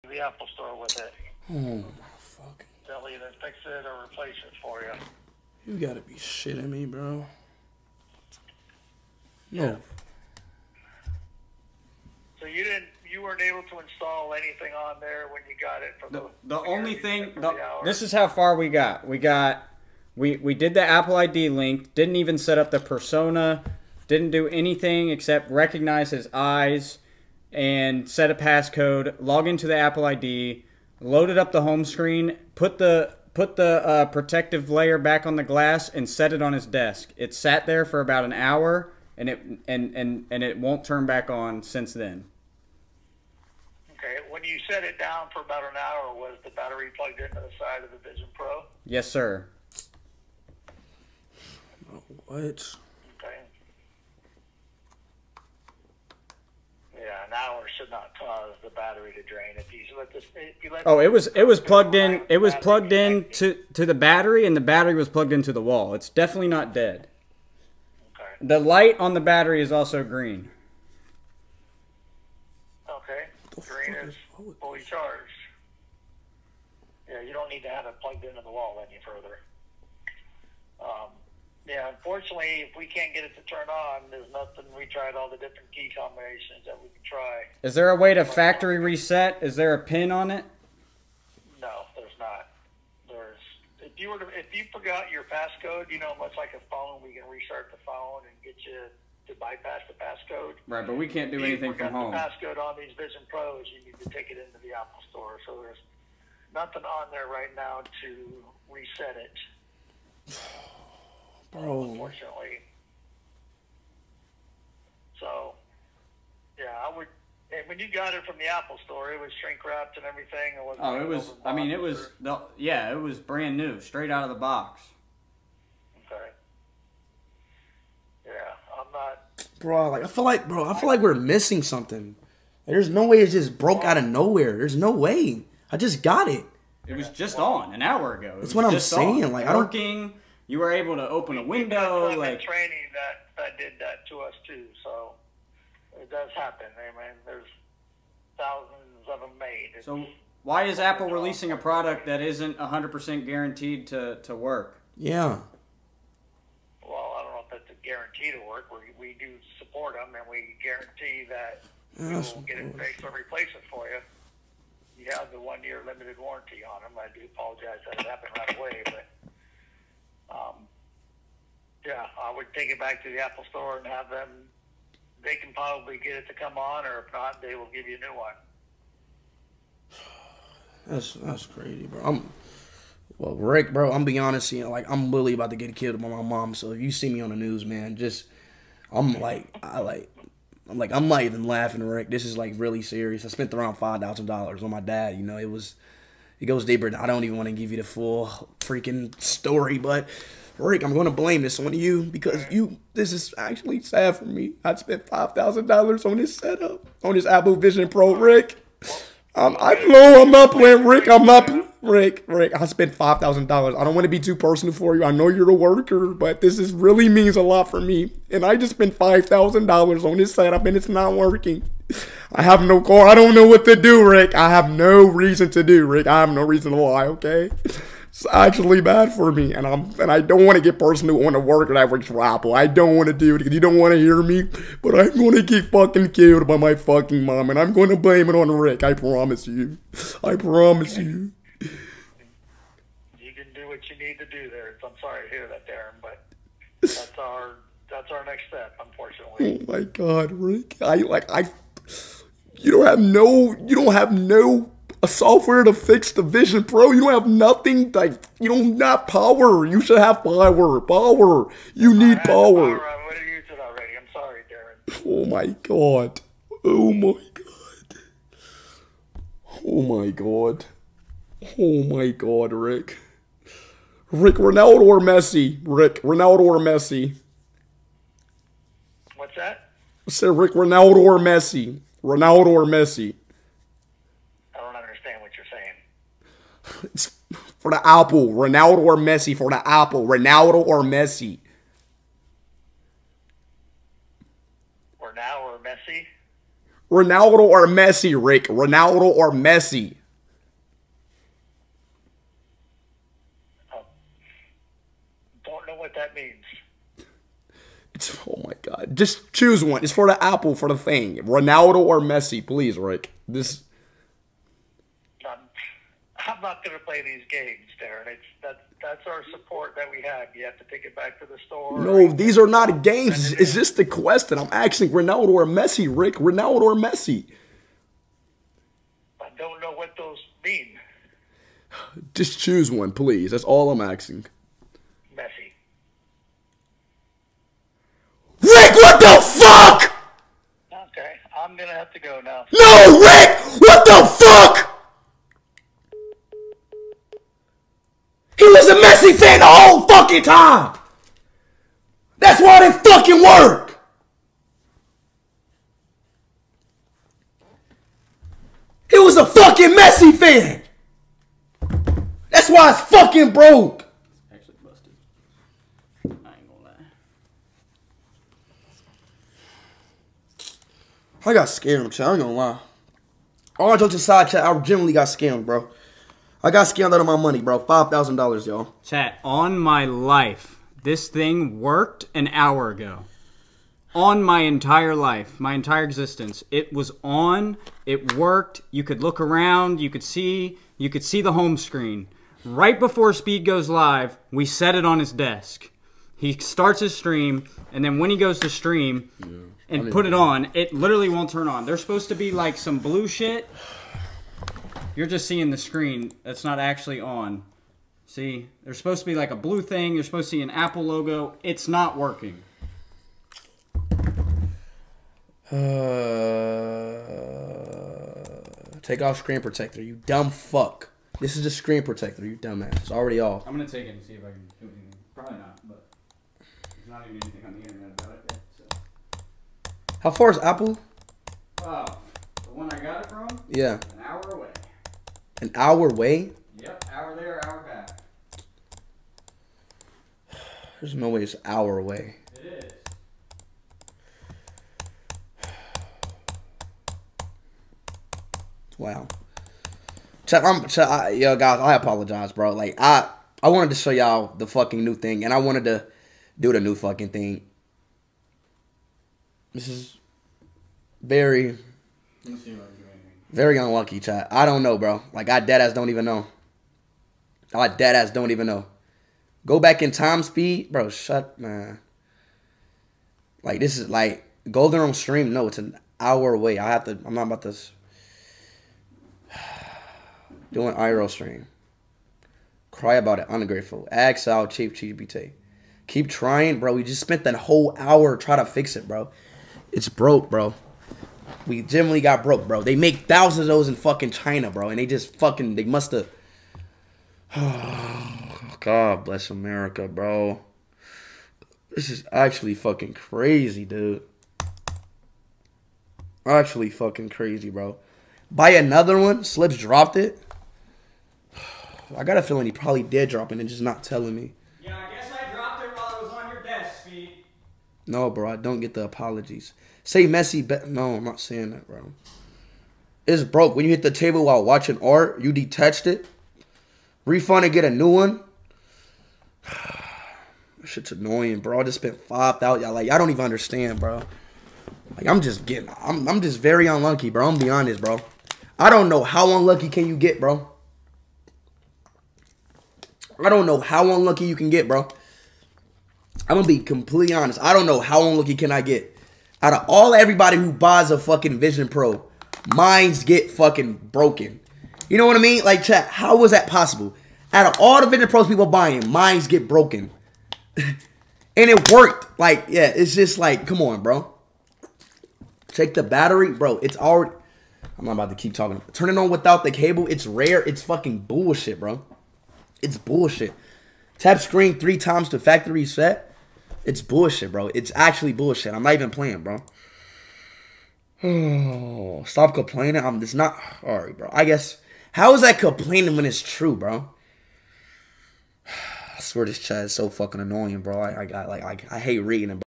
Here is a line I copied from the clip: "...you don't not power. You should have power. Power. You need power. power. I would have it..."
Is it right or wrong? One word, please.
right.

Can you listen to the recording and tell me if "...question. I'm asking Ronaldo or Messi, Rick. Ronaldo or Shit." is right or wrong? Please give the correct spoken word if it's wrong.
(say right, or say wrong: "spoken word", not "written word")
wrong: "Messi", not "Shit".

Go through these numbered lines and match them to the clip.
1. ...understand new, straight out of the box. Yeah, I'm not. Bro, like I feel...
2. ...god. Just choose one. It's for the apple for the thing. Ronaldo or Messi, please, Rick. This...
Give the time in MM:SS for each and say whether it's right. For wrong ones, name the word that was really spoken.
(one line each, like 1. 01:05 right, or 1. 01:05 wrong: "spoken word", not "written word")
1. 02:03 wrong: "brand", not "understand"
2. 05:08 right.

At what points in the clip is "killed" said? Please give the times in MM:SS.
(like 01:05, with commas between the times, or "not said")
03:05, 03:56.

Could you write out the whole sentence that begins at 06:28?
You could look around, you could see, you could see the home screen.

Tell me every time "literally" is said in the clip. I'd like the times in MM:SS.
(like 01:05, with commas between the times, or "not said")
03:05, 06:40.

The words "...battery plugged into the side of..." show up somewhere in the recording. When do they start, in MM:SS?
00:46.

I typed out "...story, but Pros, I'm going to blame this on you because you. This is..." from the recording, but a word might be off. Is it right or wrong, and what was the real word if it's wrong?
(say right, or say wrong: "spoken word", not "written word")
wrong: "Rick", not "Pros".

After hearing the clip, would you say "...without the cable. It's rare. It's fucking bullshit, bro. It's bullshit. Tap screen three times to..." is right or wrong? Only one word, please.
right.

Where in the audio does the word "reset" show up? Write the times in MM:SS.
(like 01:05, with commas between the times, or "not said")
01:28, 01:48, 09:35.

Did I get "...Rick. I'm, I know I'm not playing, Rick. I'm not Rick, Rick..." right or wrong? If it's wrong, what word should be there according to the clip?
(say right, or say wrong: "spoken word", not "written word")
right.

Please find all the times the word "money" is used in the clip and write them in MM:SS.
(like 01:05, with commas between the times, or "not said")
06:17.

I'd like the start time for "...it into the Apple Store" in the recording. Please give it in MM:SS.
01:44.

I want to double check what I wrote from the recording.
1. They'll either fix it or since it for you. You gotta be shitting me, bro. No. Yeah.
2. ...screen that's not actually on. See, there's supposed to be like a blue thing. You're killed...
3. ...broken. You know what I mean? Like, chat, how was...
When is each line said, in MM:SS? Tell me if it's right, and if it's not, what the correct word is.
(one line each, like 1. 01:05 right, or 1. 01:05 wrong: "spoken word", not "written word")
1. 00:02 wrong: "replace", not "since"
2. 06:45 wrong: "supposed", not "killed"
3. 09:13 right.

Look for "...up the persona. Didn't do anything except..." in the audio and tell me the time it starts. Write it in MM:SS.
00:22.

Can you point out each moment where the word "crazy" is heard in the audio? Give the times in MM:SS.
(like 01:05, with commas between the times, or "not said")
03:01, 08:22, 08:27.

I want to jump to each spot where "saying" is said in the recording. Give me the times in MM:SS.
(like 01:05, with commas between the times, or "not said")
02:18, 04:45, 08:41.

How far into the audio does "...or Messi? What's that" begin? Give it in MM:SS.
04:36.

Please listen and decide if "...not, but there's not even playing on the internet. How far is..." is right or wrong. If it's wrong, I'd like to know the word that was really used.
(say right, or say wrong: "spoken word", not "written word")
wrong: "anything", not "playing".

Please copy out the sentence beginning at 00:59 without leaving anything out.
If you let this, you let oh, it was it was plugged in.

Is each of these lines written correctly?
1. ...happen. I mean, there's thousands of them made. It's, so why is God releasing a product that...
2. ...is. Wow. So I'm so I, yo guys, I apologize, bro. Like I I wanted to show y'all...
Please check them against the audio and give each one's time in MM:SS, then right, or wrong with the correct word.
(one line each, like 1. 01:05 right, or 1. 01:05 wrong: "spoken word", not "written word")
1. 02:26 wrong: "Apple", not "God"
2. 07:25 right.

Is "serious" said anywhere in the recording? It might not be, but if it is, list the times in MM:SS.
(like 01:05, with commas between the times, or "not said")
03:12.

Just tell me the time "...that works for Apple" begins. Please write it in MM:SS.
03:51.